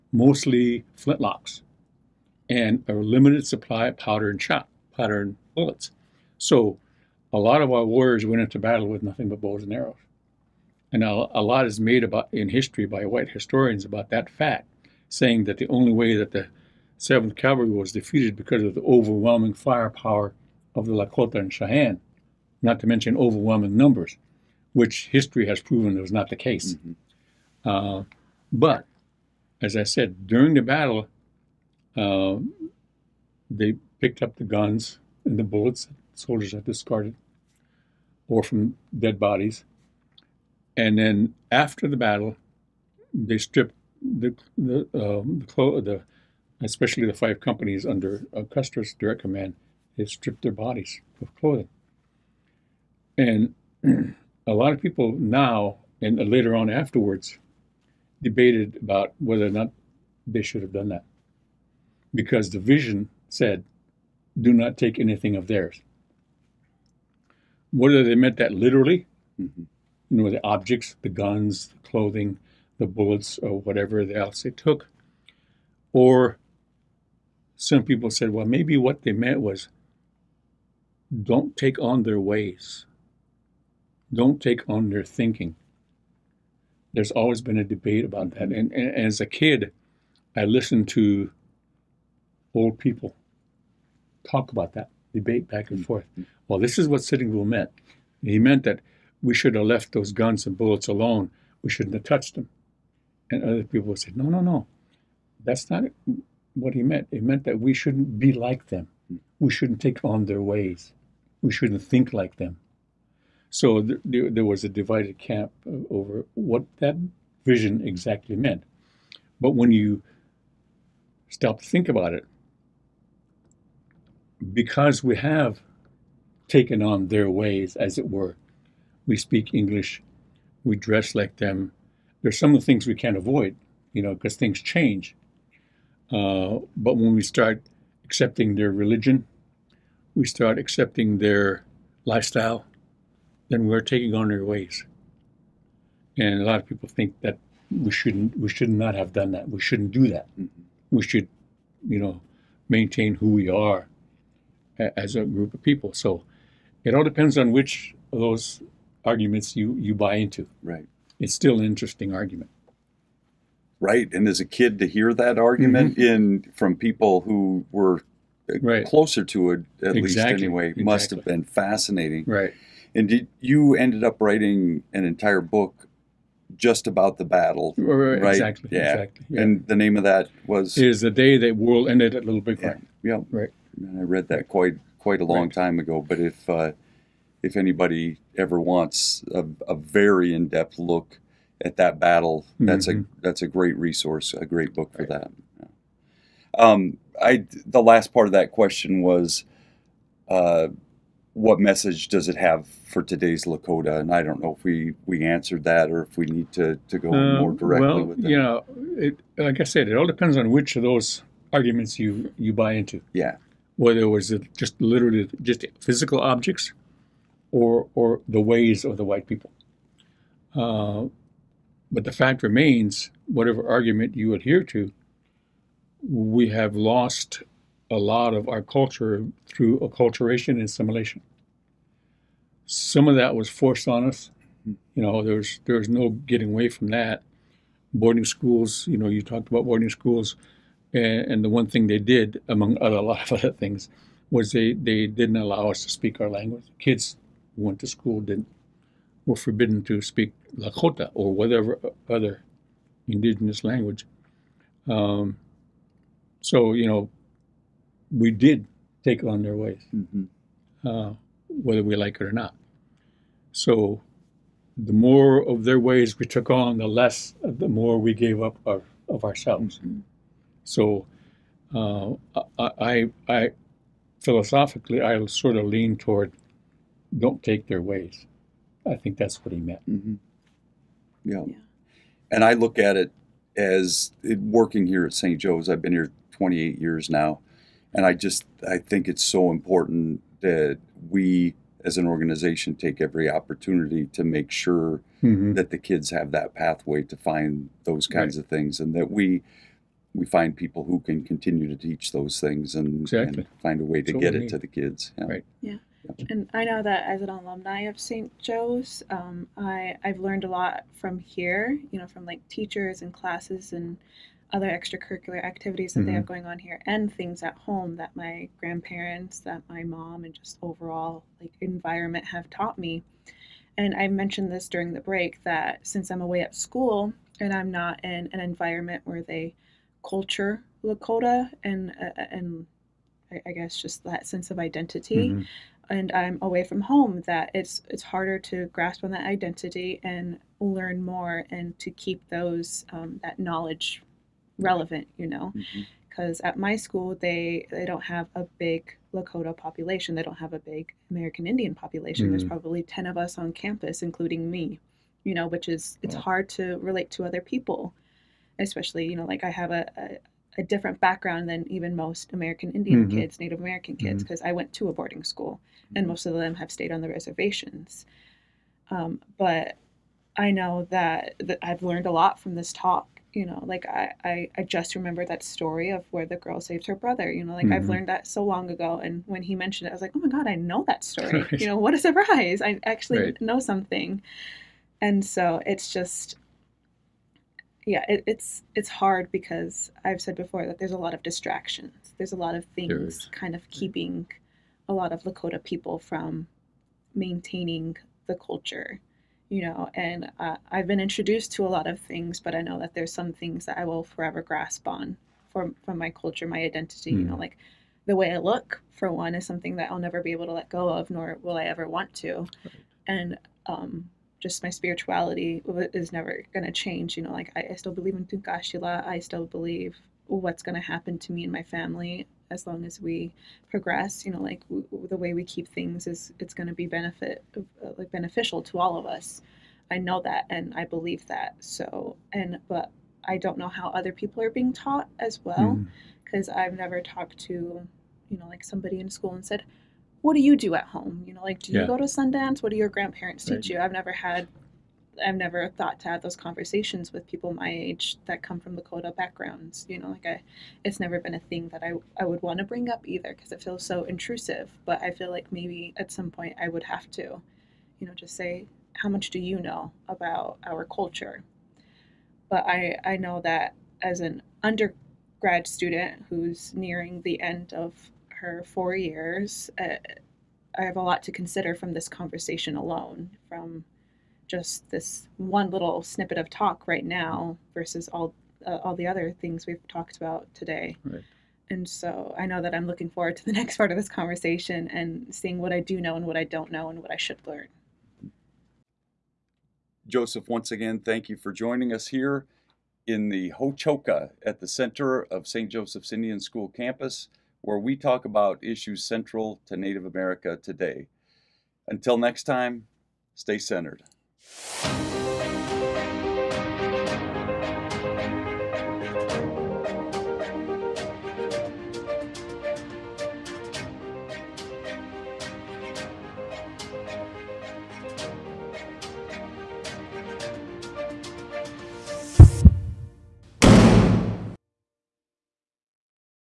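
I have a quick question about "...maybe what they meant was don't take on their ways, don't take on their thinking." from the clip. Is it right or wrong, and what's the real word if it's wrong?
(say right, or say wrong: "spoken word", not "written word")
right.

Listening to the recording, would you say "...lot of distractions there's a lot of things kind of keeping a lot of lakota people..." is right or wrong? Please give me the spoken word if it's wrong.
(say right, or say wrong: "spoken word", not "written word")
right.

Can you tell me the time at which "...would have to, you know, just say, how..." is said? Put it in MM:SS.
07:36.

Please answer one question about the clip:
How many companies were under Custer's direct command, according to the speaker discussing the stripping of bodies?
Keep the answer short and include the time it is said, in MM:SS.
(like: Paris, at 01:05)
5, at 00:47.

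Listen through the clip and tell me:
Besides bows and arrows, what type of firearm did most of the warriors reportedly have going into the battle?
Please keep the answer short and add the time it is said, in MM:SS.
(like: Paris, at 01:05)
flintlocks, at 00:00.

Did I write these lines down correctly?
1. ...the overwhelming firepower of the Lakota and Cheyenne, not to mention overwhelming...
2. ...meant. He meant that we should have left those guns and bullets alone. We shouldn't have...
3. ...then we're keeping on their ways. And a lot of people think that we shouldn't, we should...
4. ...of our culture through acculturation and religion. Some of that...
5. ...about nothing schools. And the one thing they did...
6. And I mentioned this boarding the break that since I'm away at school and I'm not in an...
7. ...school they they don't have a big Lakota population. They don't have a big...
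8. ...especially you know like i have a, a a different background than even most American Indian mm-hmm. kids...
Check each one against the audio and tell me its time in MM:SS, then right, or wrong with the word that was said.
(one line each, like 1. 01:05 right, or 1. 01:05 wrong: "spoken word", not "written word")
1. 00:18 right
2. 01:37 right
3. 02:23 wrong: "taking", not "keeping"
4. 03:48 wrong: "assimilation", not "religion"
5. 03:59 wrong: "boarding", not "nothing"
6. 05:23 wrong: "during", not "boarding"
7. 05:46 right
8. 05:58 right.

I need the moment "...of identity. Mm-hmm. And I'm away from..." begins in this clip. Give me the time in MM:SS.
05:34.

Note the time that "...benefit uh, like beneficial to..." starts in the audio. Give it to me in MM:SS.
07:06.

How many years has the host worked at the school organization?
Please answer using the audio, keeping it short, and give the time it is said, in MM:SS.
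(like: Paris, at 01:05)
28, at 04:46.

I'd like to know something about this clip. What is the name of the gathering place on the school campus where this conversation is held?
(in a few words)
Hochoka.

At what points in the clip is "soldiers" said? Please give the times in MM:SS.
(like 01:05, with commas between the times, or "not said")
00:36.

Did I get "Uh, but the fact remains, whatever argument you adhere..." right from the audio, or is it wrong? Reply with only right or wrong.
right.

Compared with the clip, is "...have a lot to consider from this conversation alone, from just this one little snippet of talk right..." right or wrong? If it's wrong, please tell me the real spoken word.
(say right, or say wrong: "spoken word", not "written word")
right.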